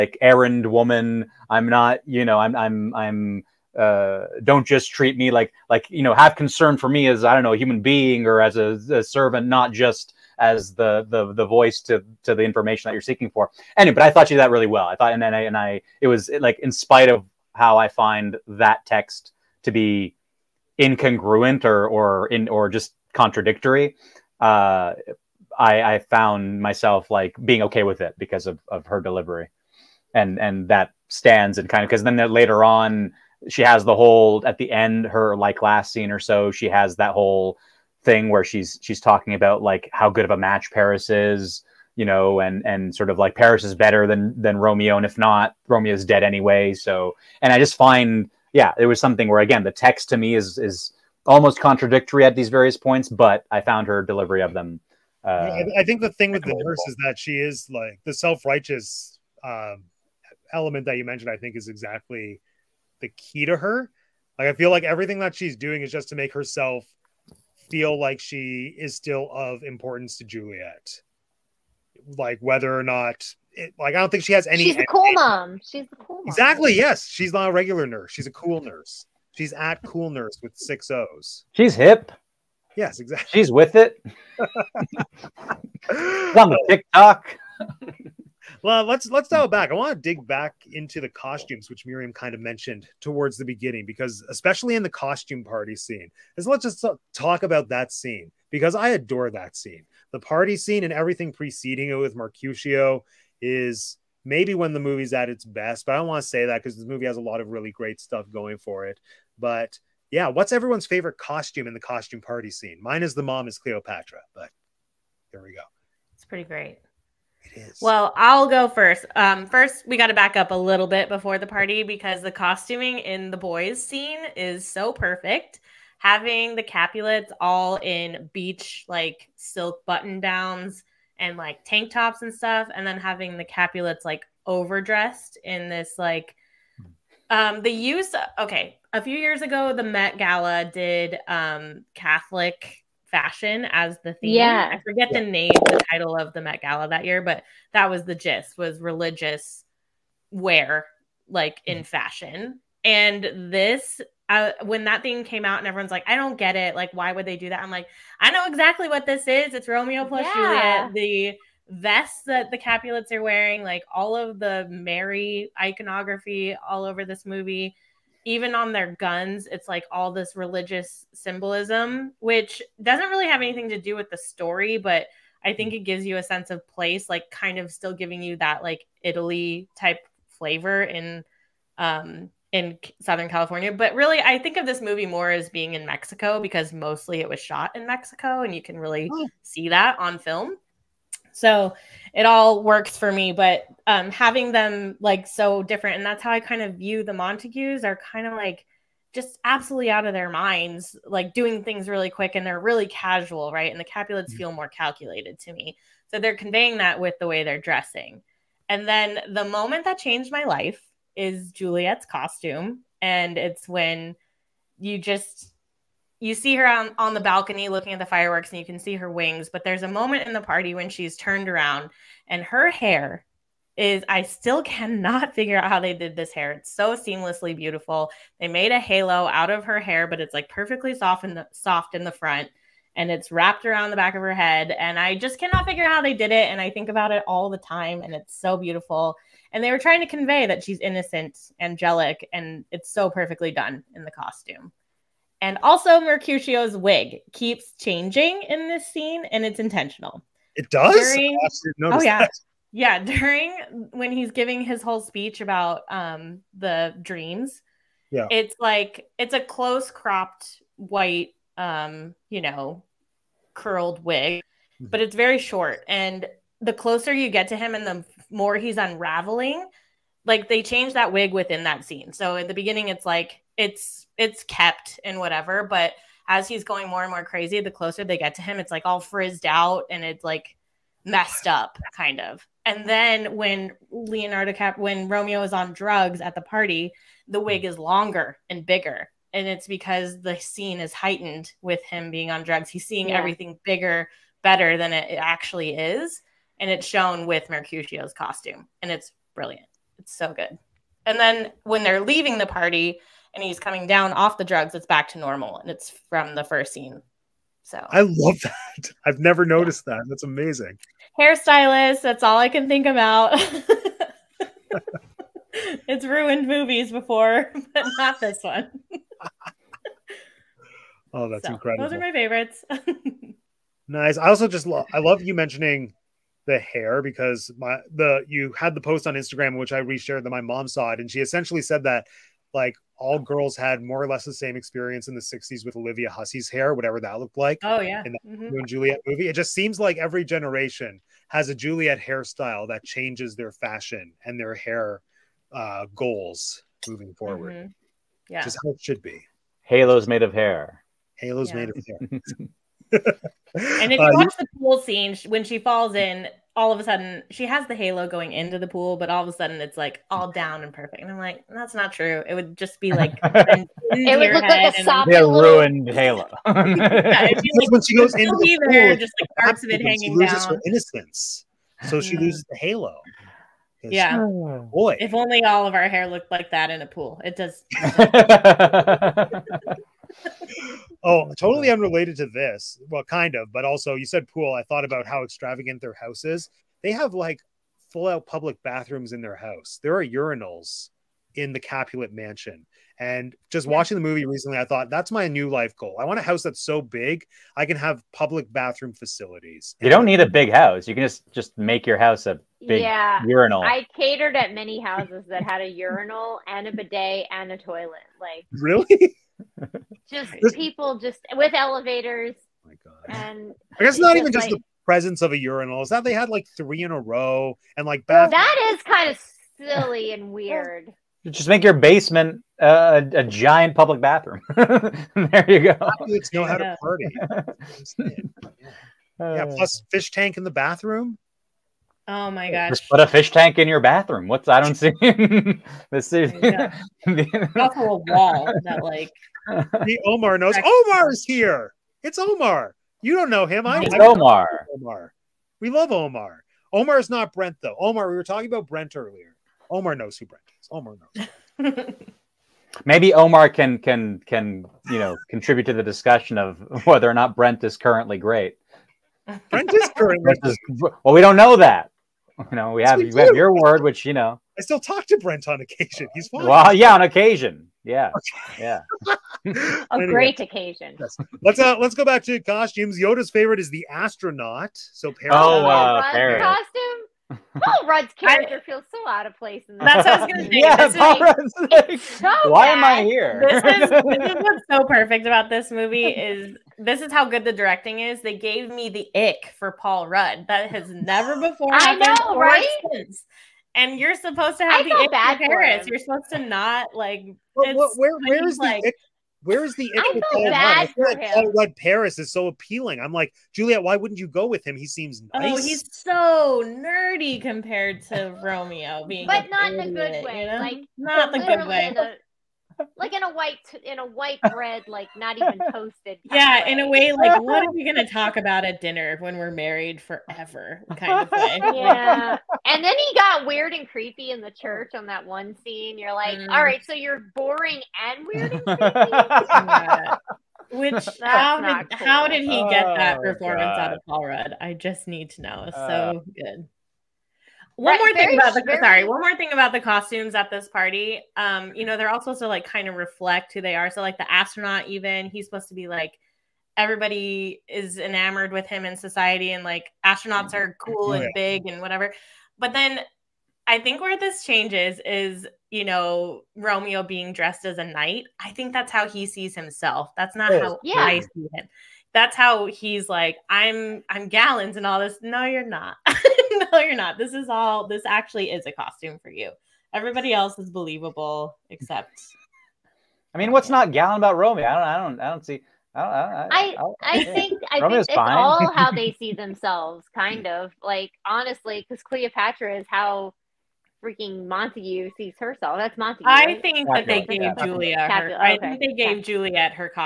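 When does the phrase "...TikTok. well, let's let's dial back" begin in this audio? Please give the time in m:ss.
1:26.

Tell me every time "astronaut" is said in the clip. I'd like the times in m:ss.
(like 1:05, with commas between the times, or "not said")
7:53, 9:04, 9:10.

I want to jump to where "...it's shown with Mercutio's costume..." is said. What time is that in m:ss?
4:56.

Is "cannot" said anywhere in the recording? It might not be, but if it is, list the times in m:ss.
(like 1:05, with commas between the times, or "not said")
3:44, 3:55.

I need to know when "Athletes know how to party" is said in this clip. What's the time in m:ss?
7:05.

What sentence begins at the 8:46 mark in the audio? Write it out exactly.
all right so you're boring and weird and creepy Which how did, cool.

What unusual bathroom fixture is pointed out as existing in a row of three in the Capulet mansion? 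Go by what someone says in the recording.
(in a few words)
Urinals.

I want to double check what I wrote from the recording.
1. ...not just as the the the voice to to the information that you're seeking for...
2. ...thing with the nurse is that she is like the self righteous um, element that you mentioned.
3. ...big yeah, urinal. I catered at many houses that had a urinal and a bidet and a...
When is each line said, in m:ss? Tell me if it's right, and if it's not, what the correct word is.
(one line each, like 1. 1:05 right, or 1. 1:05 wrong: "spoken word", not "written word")
1. 0:09 right
2. 0:56 right
3. 6:42 right.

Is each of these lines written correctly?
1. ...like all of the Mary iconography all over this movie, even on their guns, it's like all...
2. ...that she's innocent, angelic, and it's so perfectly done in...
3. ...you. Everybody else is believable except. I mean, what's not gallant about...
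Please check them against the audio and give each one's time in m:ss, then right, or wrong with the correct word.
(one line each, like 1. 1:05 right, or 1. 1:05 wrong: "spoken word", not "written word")
1. 2:43 right
2. 4:00 right
3. 9:29 right.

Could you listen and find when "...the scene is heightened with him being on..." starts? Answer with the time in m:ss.
4:50.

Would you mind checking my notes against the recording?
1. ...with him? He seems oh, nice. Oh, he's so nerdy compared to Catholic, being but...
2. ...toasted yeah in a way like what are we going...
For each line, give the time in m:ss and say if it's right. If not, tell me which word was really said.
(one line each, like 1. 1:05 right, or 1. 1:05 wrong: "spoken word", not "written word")
1. 8:24 wrong: "Romeo", not "Catholic"
2. 8:35 right.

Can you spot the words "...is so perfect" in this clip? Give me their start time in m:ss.
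2:04.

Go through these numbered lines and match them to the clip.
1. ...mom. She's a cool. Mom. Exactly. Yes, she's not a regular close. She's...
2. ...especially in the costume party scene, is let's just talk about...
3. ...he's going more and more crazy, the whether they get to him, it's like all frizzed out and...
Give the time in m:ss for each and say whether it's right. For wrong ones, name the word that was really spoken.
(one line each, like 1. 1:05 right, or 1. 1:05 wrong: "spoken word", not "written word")
1. 1:15 wrong: "nurse", not "close"
2. 1:34 right
3. 4:36 wrong: "closer", not "whether".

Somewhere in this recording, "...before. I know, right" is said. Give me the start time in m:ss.
8:11.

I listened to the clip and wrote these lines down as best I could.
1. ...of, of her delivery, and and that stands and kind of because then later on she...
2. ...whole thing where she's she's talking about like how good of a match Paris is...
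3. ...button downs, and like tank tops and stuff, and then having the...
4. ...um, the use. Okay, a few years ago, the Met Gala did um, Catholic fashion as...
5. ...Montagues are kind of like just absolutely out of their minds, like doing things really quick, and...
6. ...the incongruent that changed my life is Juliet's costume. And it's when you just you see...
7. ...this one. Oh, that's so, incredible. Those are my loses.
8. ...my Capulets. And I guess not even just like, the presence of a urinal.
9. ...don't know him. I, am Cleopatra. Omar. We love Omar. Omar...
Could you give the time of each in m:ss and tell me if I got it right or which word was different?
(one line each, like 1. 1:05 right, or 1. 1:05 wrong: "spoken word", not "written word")
1. 0:28 right
2. 0:37 right
3. 2:09 right
4. 2:17 right
5. 3:17 right
6. 3:29 wrong: "moment", not "incongruent"
7. 5:18 wrong: "favorites", not "loses"
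8. 6:52 wrong: "God", not "Capulets"
9. 7:23 wrong: "Omar", not "Cleopatra".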